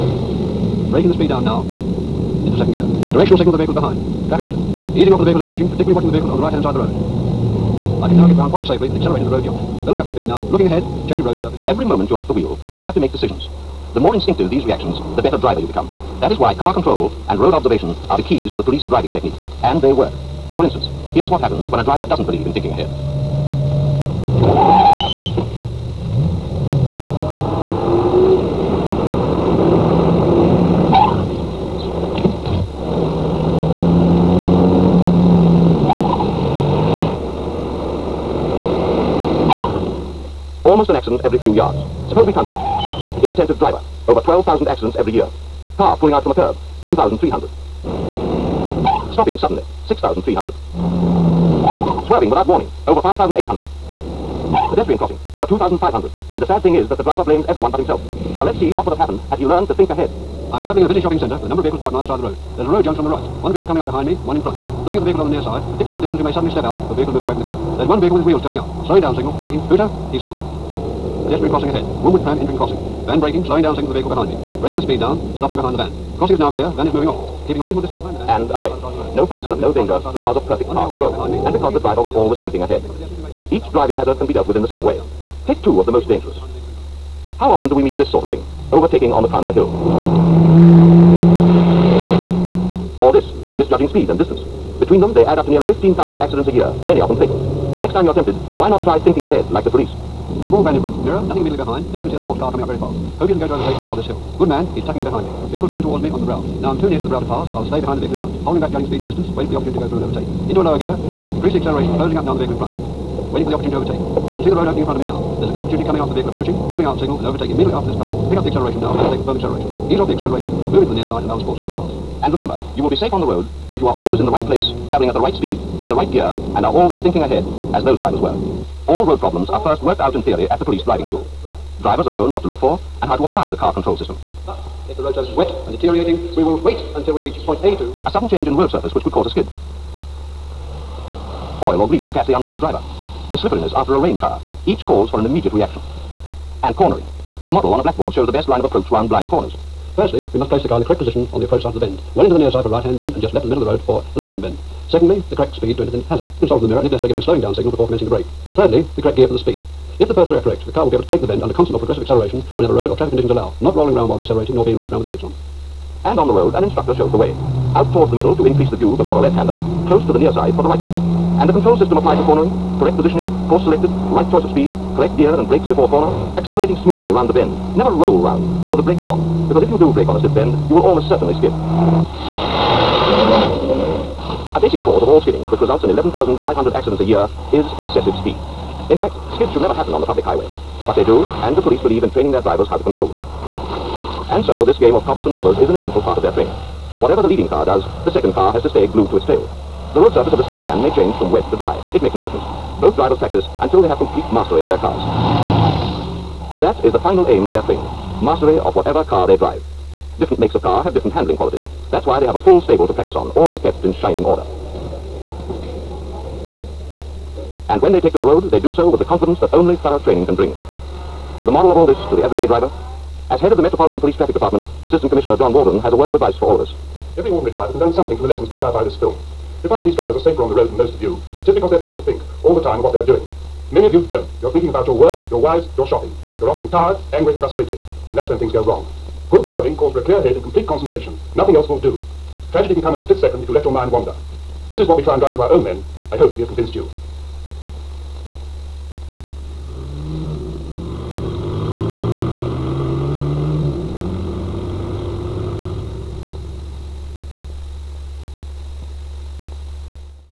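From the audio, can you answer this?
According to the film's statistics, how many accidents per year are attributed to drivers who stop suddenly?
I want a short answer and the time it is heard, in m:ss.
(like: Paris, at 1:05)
6,300, at 0:49.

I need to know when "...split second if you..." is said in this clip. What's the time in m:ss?
4:03.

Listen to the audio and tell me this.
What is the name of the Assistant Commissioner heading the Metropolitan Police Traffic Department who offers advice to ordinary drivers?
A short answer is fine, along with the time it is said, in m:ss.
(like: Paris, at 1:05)
John Walden, at 3:45.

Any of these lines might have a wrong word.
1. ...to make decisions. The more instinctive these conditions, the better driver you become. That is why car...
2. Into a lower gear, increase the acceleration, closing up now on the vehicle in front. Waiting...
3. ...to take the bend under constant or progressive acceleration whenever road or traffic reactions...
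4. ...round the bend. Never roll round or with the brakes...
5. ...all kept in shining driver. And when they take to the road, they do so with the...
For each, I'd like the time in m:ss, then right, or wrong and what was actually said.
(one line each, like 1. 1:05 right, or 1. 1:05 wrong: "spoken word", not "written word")
1. 0:12 wrong: "reactions", not "conditions"
2. 1:50 right
3. 2:41 wrong: "conditions", not "reactions"
4. 2:57 right
5. 3:33 wrong: "order", not "driver".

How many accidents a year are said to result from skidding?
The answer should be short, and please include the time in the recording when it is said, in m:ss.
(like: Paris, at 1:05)
11,500, at 3:05.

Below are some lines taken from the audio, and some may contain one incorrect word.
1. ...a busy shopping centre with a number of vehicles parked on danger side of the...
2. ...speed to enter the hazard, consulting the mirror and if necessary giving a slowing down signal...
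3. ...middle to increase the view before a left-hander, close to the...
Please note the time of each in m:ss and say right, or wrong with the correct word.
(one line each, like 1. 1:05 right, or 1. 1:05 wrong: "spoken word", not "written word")
1. 1:00 wrong: "either", not "danger"
2. 2:35 right
3. 2:48 right.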